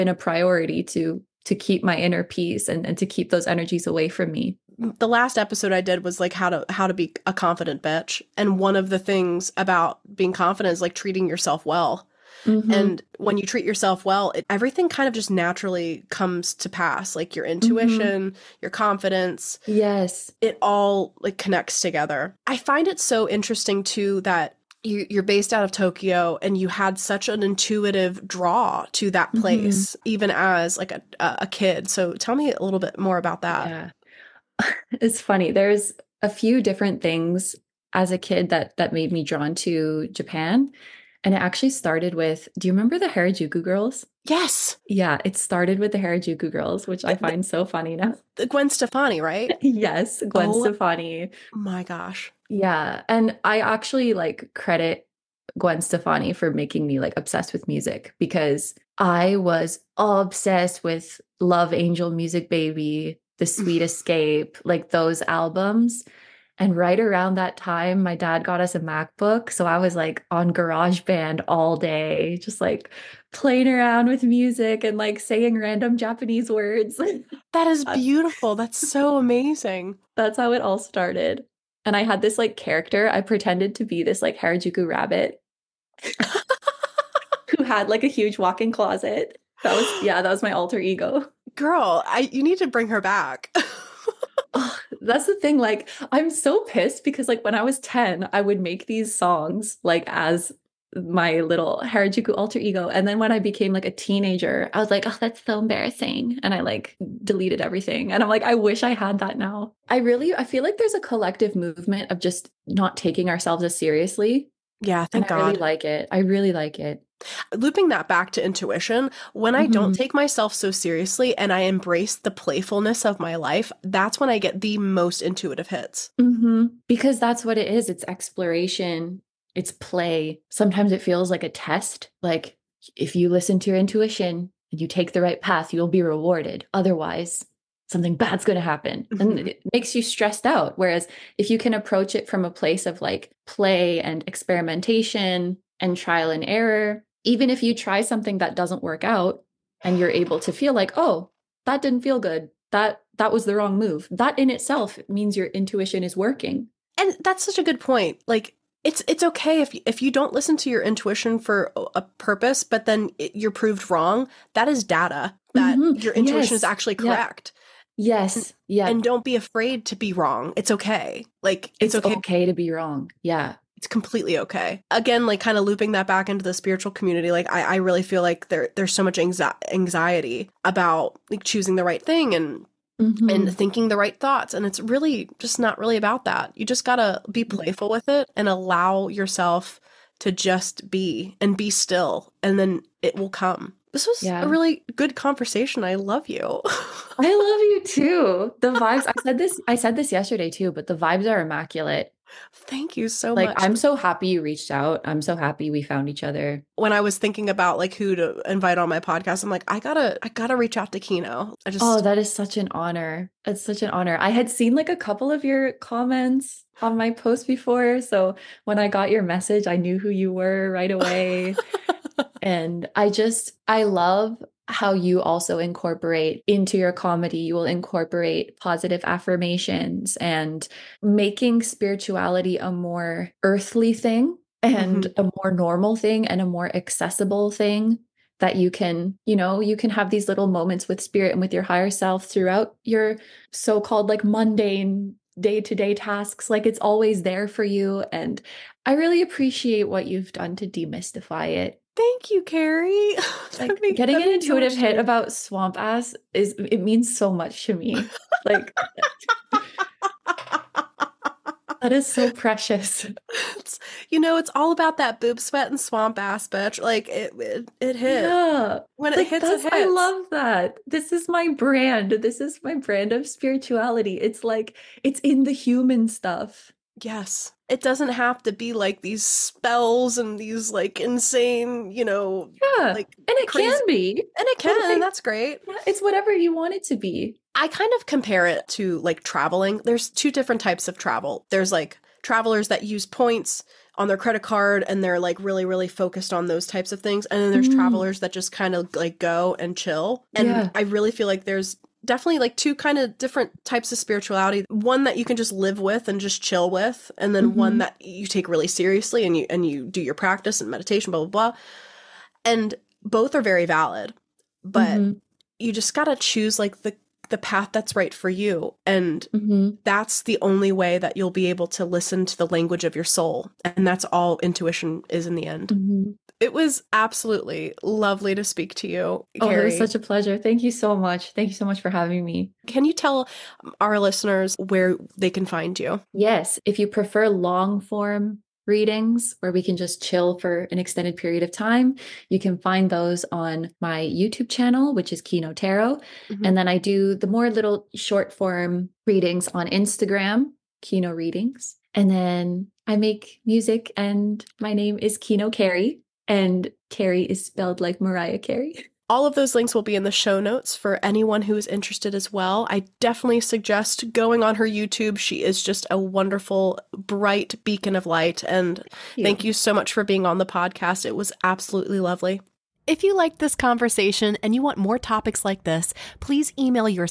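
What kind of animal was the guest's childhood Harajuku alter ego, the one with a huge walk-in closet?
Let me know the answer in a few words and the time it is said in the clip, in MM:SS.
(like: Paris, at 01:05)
rabbit, at 01:24.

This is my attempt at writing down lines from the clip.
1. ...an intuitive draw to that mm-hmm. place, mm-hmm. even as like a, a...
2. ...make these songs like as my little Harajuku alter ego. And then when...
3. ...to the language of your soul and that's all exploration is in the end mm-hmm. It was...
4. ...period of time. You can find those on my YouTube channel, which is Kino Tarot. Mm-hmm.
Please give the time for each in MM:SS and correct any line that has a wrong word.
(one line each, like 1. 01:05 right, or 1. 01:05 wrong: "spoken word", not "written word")
1. 00:27 right
2. 01:38 right
3. 05:22 wrong: "intuition", not "exploration"
4. 05:41 right.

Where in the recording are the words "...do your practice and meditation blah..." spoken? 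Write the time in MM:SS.
05:09.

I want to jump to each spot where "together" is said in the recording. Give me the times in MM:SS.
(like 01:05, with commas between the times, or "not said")
00:21.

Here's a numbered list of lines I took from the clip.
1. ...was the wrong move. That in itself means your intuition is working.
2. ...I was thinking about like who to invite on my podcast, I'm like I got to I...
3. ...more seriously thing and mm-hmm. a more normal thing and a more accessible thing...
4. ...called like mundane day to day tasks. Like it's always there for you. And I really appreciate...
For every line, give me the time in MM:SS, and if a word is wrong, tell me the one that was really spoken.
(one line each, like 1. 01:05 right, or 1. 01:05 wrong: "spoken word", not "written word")
1. 02:33 right
2. 03:26 right
3. 03:52 wrong: "earthly", not "seriously"
4. 04:03 right.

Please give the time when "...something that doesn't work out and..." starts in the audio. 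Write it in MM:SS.
02:27.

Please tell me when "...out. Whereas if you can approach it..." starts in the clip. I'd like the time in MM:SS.
02:20.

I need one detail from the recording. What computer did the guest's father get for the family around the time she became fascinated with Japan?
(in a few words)
MacBook.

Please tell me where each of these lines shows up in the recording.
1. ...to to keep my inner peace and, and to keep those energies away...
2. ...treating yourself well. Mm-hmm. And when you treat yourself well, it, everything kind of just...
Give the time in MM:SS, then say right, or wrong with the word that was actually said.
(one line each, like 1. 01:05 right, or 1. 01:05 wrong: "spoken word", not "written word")
1. 00:00 right
2. 00:10 right.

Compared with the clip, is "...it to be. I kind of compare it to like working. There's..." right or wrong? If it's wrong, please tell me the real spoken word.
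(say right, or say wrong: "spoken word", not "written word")
wrong: "traveling", not "working".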